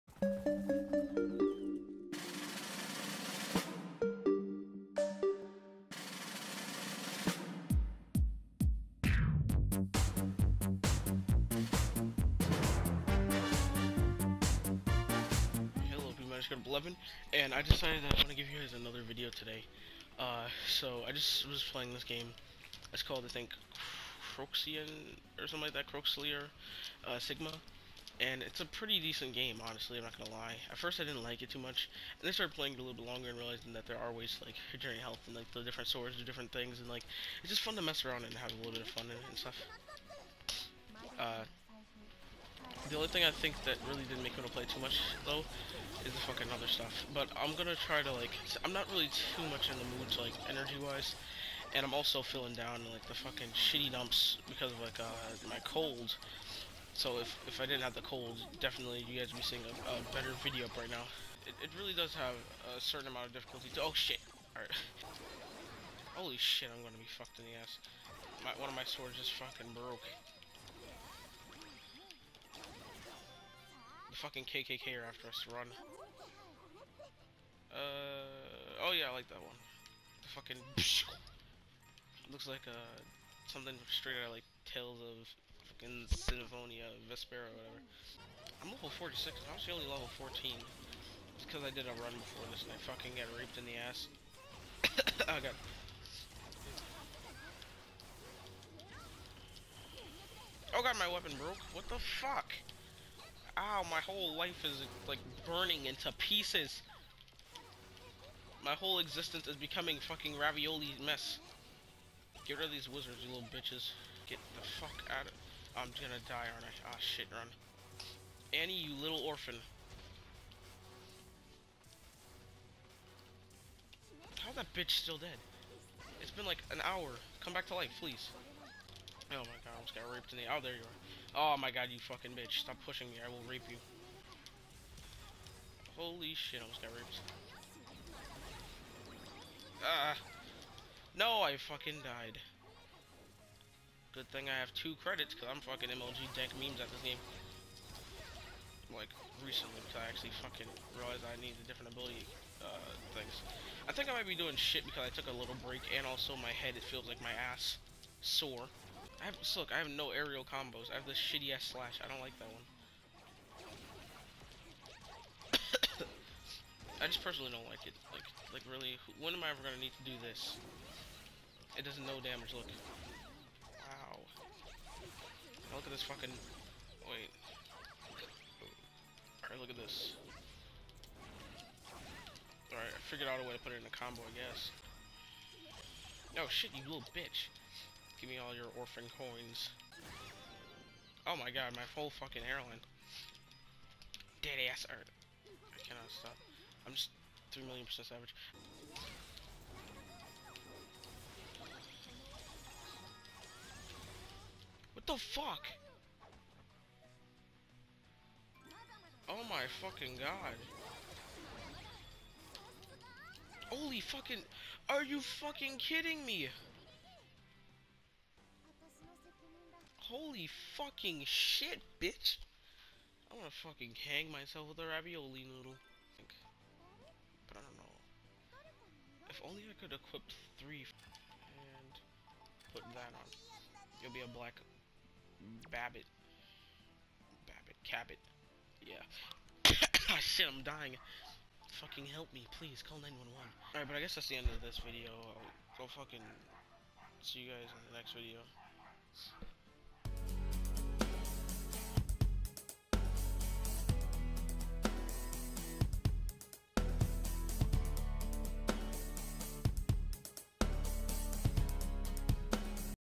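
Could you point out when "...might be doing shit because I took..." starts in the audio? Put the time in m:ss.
2:34.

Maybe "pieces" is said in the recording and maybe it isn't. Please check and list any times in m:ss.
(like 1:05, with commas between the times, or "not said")
1:46.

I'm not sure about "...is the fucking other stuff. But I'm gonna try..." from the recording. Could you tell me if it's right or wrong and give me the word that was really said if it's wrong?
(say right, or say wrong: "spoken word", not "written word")
right.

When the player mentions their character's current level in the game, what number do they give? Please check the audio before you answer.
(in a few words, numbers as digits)
46.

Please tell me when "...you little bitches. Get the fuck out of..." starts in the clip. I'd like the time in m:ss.
1:53.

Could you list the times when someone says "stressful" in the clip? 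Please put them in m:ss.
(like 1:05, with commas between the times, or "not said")
not said.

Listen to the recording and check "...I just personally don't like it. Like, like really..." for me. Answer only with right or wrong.
right.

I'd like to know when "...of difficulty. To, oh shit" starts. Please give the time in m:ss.
1:03.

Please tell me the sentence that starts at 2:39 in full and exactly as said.
I have, so look, I have no aerial combos.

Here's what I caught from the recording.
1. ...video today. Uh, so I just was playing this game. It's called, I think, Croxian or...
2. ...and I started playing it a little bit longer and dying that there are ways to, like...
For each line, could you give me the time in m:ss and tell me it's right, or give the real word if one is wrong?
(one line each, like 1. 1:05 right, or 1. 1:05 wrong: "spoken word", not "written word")
1. 0:19 right
2. 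0:32 wrong: "realizing", not "dying".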